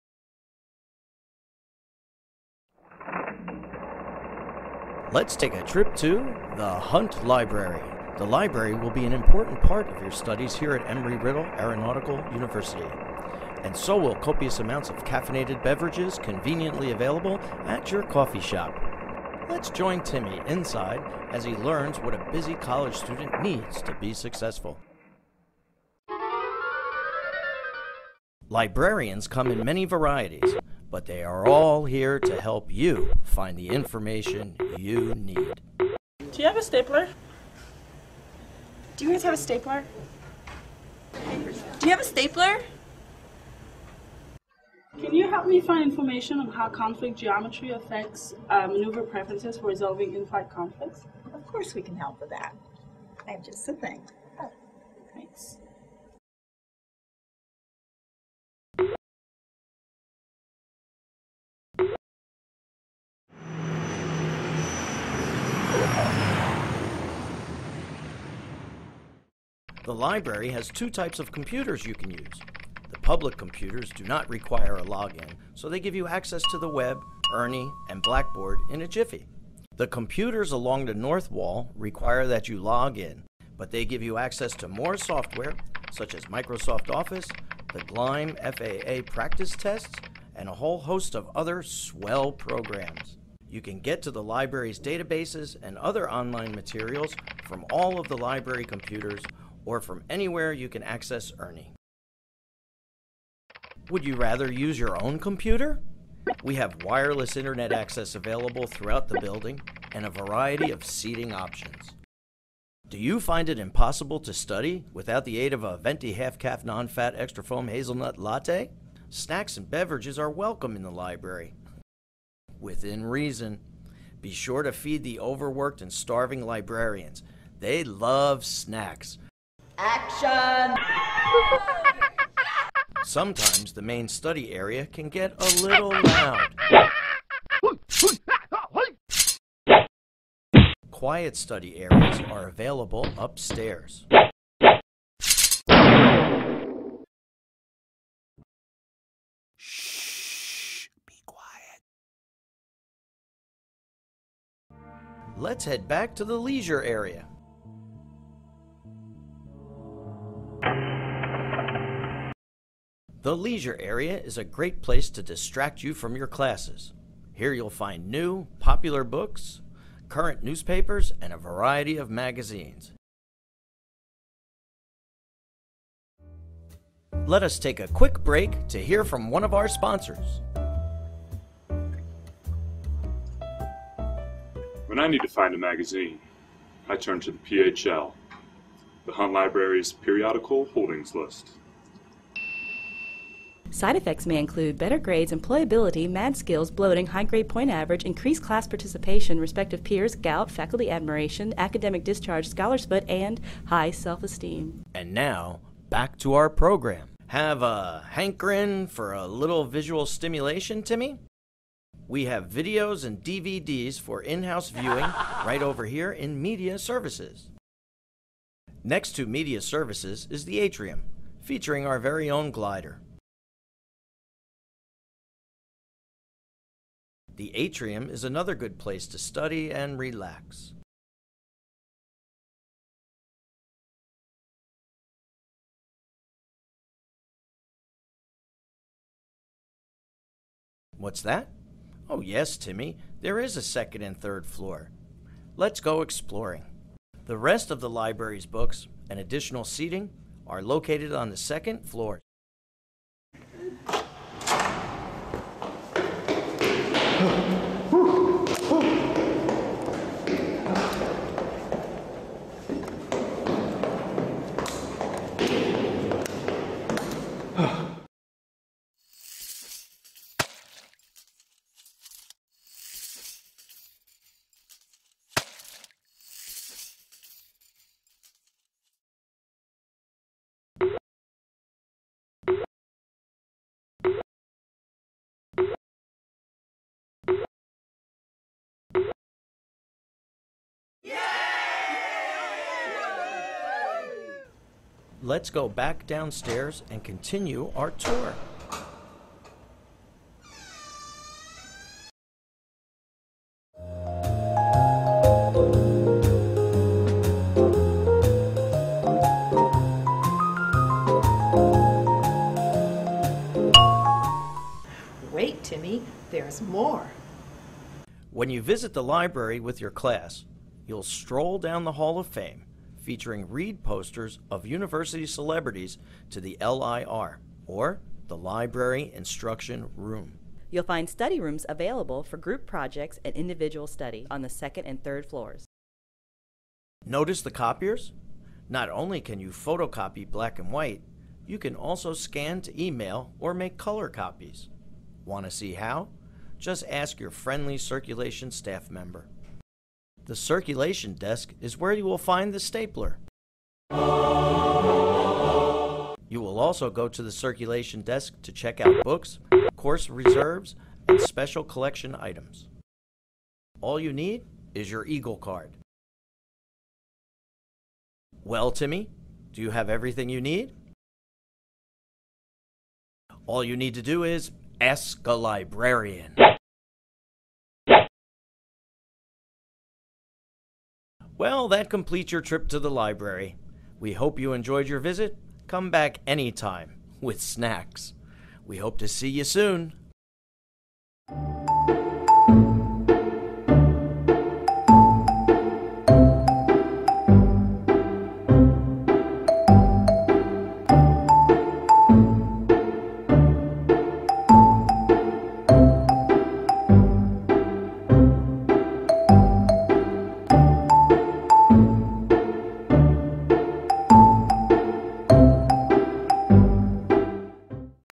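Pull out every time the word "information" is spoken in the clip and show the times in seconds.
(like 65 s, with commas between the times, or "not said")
33 s, 45 s.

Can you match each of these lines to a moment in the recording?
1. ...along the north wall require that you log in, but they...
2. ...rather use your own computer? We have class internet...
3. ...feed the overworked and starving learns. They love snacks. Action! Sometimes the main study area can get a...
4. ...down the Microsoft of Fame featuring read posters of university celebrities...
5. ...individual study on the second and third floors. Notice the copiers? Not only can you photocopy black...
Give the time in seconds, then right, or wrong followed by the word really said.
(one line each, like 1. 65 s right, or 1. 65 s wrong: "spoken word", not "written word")
1. 80 s right
2. 104 s wrong: "wireless", not "class"
3. 124 s wrong: "librarians", not "learns"
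4. 321 s wrong: "Hall", not "Microsoft"
5. 333 s right.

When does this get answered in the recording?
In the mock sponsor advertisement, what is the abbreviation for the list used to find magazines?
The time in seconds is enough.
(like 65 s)
187 s.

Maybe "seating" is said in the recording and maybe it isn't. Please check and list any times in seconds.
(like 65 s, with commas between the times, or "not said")
110 s, 249 s.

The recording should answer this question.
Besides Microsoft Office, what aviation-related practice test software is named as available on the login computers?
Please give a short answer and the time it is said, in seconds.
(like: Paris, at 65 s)
Gleim FAA practice tests, at 87 s.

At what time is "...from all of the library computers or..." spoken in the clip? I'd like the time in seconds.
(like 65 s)
97 s.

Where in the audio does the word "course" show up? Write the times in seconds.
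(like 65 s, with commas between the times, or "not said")
51 s, 359 s.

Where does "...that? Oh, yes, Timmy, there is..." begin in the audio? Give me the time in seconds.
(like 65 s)
241 s.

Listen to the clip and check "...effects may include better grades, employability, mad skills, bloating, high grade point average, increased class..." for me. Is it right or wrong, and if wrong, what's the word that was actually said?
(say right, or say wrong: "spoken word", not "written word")
right.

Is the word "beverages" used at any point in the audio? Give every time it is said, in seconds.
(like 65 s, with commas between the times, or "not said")
15 s, 119 s.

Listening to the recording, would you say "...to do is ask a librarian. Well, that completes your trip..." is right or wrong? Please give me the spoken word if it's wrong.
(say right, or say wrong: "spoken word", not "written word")
right.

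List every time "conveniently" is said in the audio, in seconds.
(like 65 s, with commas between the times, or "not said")
16 s.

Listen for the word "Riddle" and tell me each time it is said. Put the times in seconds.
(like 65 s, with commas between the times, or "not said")
10 s.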